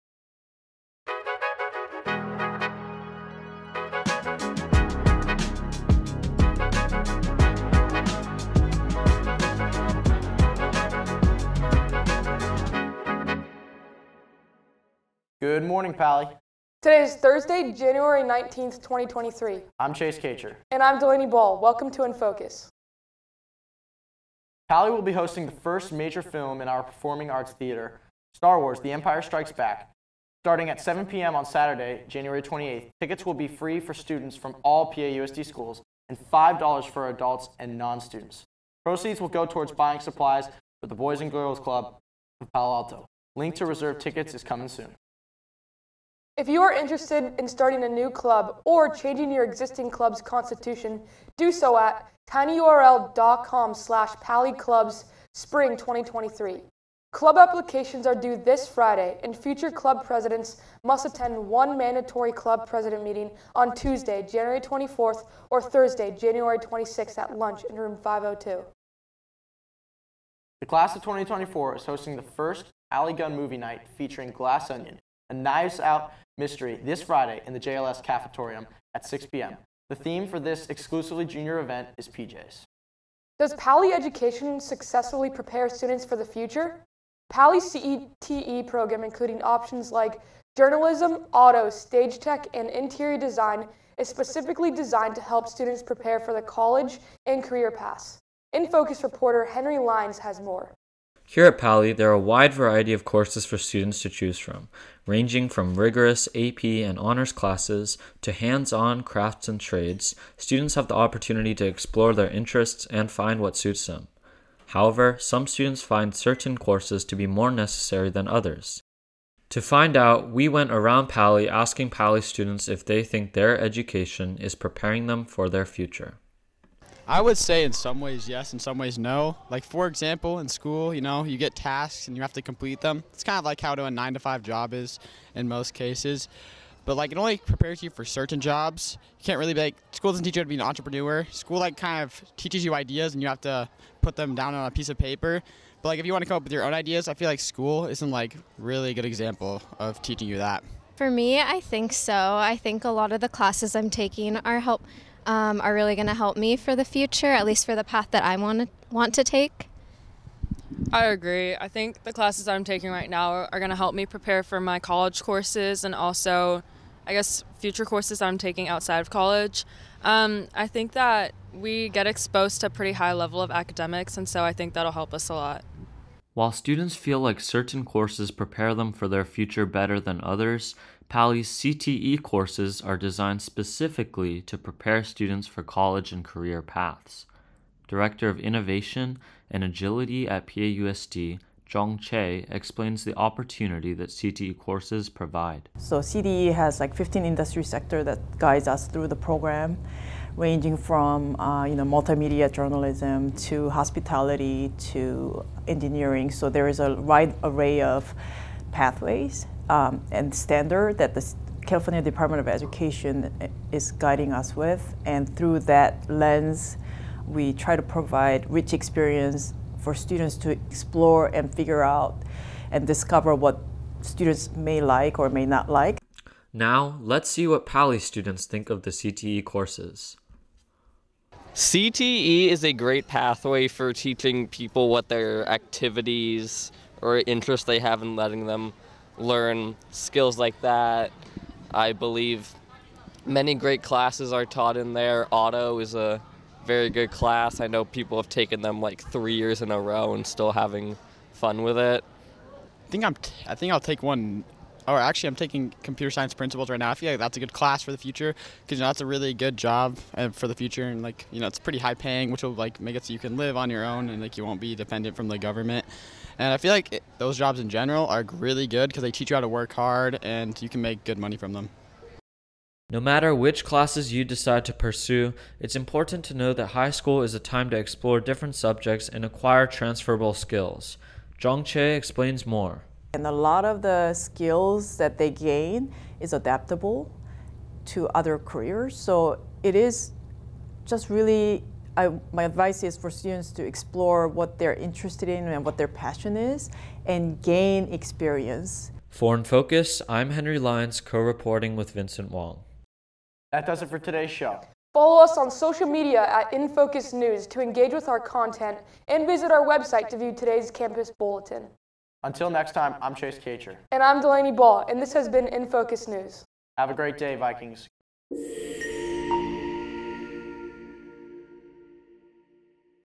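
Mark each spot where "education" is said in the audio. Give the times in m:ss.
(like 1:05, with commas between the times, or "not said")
1:23, 2:03, 3:32.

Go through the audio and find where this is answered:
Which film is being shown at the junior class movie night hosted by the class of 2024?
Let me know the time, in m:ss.
1:14.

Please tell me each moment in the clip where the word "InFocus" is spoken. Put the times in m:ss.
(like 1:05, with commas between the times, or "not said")
5:06, 5:15.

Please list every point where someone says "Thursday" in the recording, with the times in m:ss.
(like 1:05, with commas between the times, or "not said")
0:17, 1:05.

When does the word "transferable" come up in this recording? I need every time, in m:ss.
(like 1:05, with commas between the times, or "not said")
4:39.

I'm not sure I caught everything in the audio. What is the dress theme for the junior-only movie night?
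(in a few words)
PJs.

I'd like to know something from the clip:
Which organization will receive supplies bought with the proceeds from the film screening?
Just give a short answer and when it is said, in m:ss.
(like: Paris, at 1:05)
Boys and Girls Club of Palo Alto, at 0:40.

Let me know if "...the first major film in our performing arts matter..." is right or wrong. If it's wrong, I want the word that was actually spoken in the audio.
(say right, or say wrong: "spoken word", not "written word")
wrong: "theater", not "matter".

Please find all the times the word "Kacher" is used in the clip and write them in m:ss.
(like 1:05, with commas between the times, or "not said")
0:20, 5:13.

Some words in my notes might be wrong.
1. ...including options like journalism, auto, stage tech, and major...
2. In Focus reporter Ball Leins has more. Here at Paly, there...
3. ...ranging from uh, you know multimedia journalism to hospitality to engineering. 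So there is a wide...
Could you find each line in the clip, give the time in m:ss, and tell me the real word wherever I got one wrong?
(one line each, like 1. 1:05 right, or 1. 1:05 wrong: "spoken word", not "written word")
1. 1:29 wrong: "interior", not "major"
2. 1:38 wrong: "Henry", not "Ball"
3. 3:20 right.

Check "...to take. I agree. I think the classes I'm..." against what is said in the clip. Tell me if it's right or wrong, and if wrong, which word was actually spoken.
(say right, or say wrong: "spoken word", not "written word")
right.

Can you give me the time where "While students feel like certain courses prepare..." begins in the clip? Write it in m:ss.
2:56.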